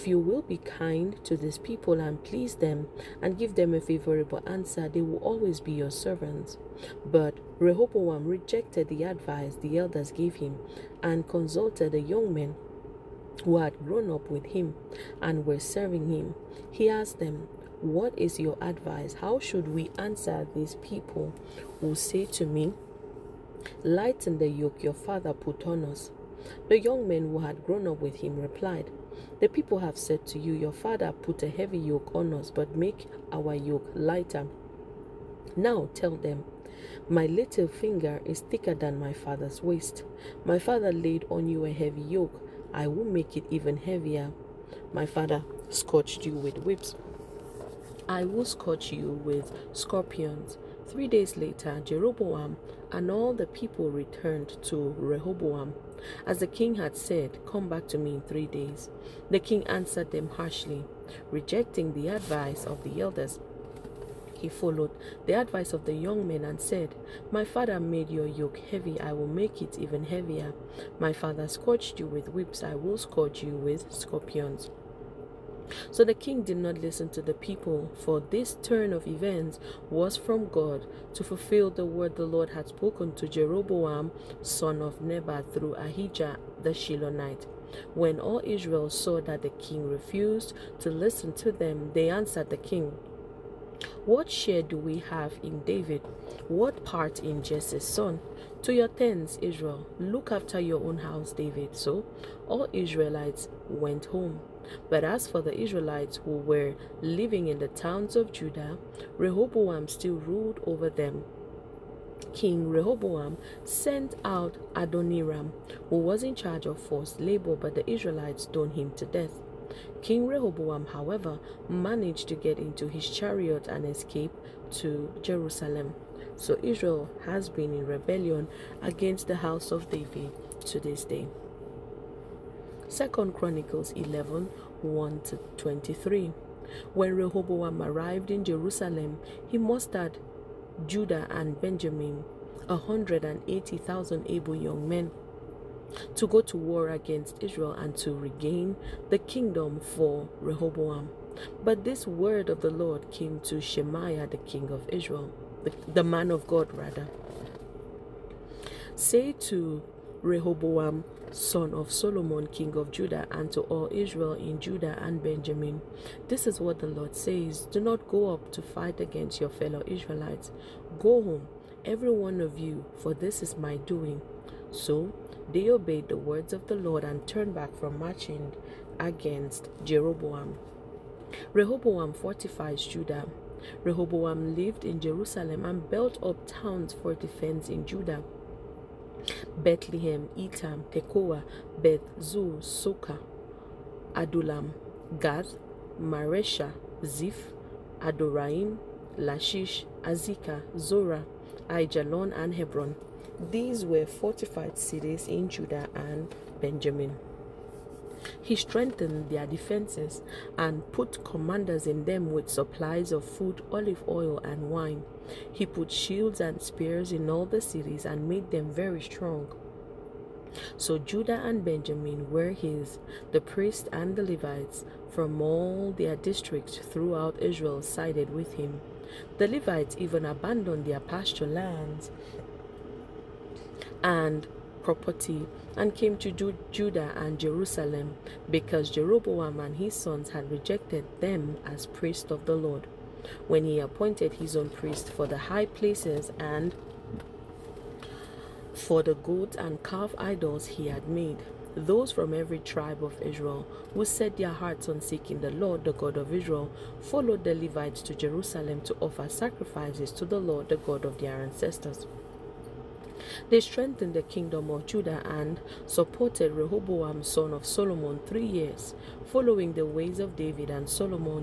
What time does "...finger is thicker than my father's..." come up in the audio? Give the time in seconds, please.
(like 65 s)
37 s.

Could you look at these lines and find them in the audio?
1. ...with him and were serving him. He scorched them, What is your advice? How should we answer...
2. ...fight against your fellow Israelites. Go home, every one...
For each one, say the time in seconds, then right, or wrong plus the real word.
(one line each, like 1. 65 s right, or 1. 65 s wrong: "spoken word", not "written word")
1. 14 s wrong: "asked", not "scorched"
2. 168 s right.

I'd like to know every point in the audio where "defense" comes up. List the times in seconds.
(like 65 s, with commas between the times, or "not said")
187 s, 209 s.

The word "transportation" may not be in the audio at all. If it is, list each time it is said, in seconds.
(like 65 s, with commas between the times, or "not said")
not said.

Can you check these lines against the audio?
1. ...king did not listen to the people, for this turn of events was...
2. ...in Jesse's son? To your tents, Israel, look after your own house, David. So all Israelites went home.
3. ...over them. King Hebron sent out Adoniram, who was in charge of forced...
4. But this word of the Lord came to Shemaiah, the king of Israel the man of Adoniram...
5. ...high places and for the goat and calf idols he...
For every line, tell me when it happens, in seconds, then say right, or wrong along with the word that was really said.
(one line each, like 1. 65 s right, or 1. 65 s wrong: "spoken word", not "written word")
1. 76 s right
2. 97 s right
3. 110 s wrong: "Rehoboam", not "Hebron"
4. 151 s wrong: "God", not "Adoniram"
5. 245 s right.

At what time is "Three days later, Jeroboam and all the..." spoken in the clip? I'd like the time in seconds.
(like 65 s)
50 s.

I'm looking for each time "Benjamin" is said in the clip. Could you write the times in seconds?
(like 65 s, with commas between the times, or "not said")
141 s, 165 s, 206 s, 221 s.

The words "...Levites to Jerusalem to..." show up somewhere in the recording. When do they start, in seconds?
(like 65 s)
257 s.